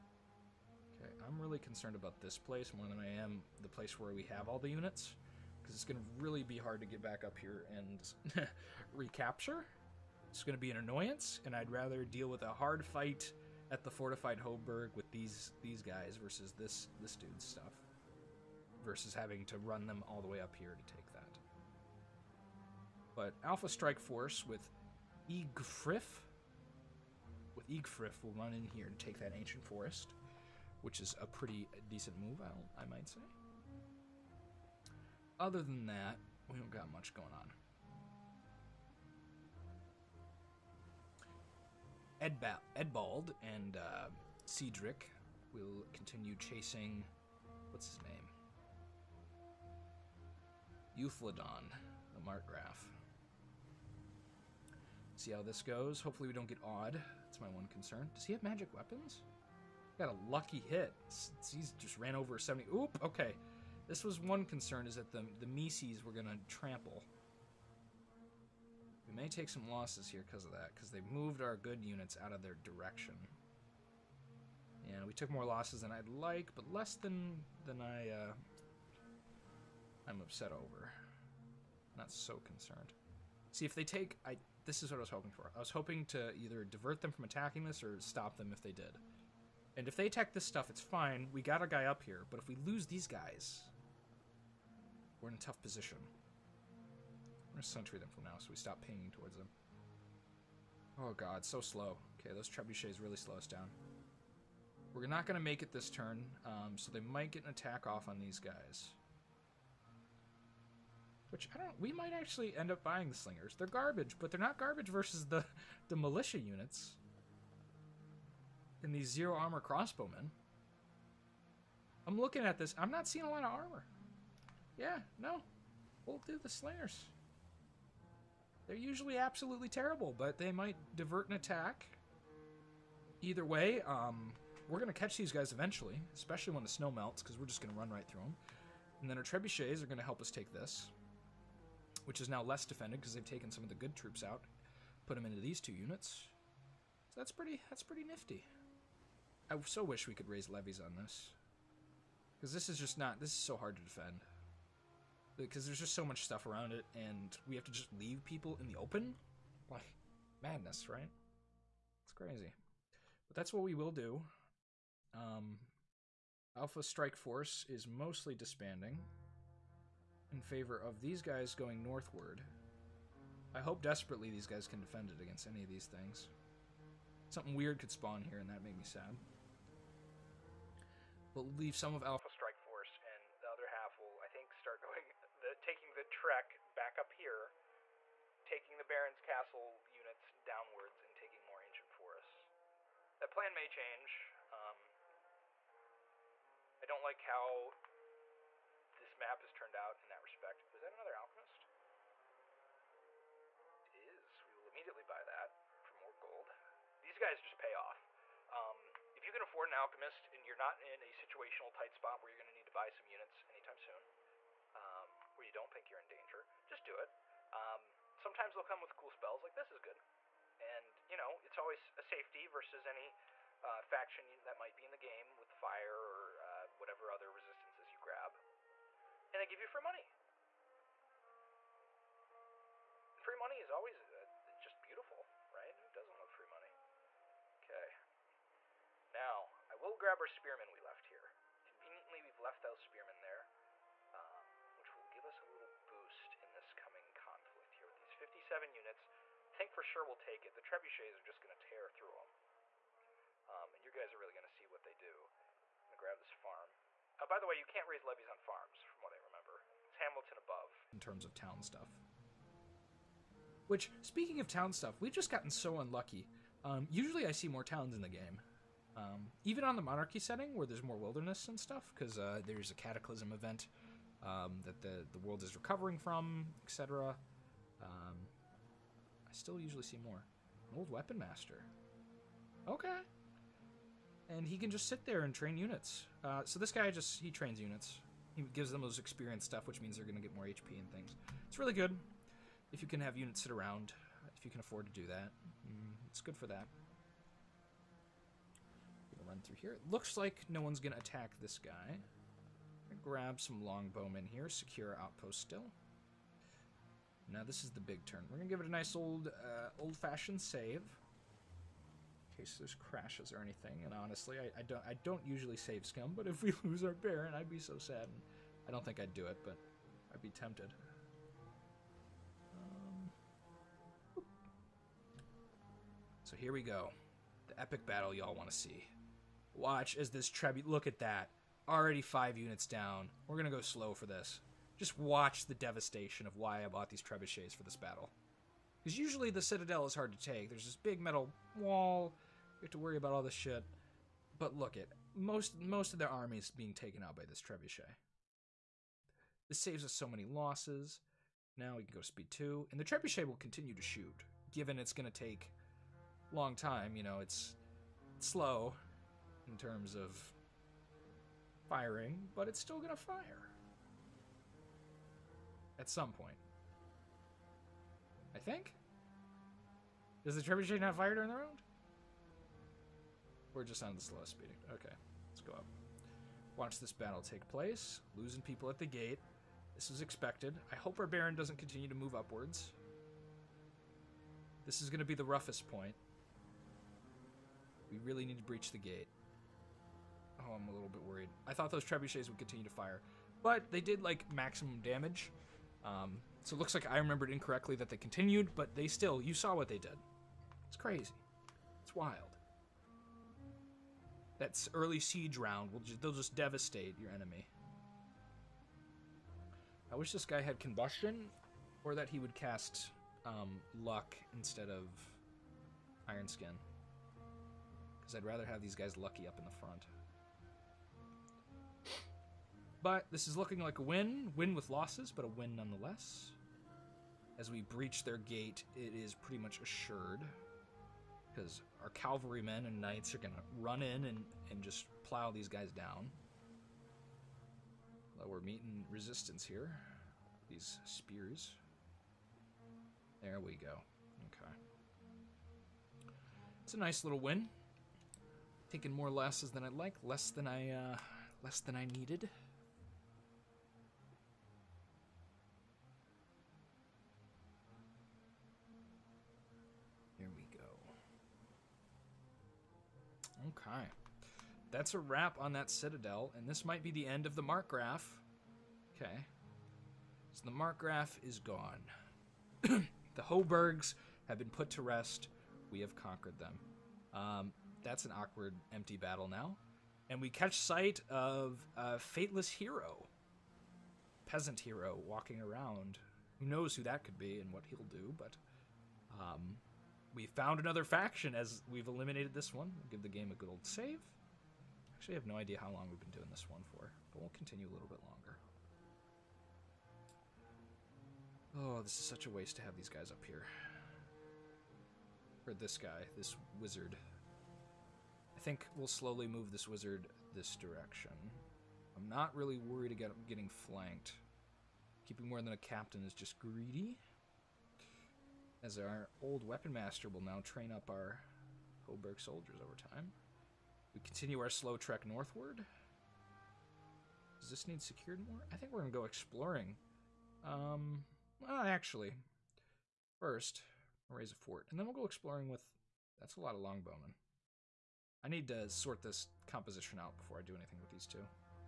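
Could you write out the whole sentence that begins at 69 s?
We may take some losses here because of that, because they moved our good units out of their direction.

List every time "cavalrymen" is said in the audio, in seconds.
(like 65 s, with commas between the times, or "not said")
431 s.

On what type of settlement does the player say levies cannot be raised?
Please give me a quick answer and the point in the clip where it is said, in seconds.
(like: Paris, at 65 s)
Farms, at 258 s.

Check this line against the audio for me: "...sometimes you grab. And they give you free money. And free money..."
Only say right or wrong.
wrong.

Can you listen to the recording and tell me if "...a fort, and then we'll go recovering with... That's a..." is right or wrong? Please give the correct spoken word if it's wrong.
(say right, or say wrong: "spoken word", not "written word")
wrong: "exploring", not "recovering".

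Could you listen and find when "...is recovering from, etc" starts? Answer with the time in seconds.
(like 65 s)
275 s.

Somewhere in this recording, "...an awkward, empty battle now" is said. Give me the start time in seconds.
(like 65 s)
478 s.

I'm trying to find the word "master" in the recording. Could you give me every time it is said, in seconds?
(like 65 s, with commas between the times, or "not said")
281 s, 519 s.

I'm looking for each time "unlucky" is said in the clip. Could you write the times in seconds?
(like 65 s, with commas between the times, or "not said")
265 s.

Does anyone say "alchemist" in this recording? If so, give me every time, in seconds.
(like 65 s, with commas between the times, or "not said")
201 s, 209 s.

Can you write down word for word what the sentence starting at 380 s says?
I hope our Baron doesn't continue to move upwards.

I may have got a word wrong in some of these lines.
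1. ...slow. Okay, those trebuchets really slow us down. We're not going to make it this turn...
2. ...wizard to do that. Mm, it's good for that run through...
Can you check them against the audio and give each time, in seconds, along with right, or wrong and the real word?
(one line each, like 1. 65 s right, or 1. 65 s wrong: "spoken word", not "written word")
1. 101 s right
2. 294 s wrong: "afford", not "wizard".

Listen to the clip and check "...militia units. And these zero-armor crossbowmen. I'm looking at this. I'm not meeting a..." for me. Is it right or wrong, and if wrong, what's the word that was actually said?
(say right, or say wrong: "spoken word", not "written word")
wrong: "seeing", not "meeting".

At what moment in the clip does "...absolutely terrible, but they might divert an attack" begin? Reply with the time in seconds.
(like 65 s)
129 s.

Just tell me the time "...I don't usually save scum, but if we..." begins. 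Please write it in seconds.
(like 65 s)
314 s.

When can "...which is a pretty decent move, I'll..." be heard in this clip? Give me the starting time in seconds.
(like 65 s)
30 s.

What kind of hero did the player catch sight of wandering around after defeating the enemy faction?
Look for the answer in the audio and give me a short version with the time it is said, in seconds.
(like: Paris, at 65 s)
Peasant hero, at 484 s.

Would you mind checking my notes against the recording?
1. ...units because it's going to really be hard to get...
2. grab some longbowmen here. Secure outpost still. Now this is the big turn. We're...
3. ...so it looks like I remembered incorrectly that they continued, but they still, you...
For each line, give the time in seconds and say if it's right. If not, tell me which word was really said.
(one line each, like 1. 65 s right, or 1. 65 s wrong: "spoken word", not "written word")
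1. 4 s right
2. 303 s right
3. 396 s right.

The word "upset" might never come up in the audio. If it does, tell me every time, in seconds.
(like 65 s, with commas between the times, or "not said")
80 s.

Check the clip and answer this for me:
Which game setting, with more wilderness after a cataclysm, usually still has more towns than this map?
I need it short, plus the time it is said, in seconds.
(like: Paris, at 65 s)
Monarchy, at 269 s.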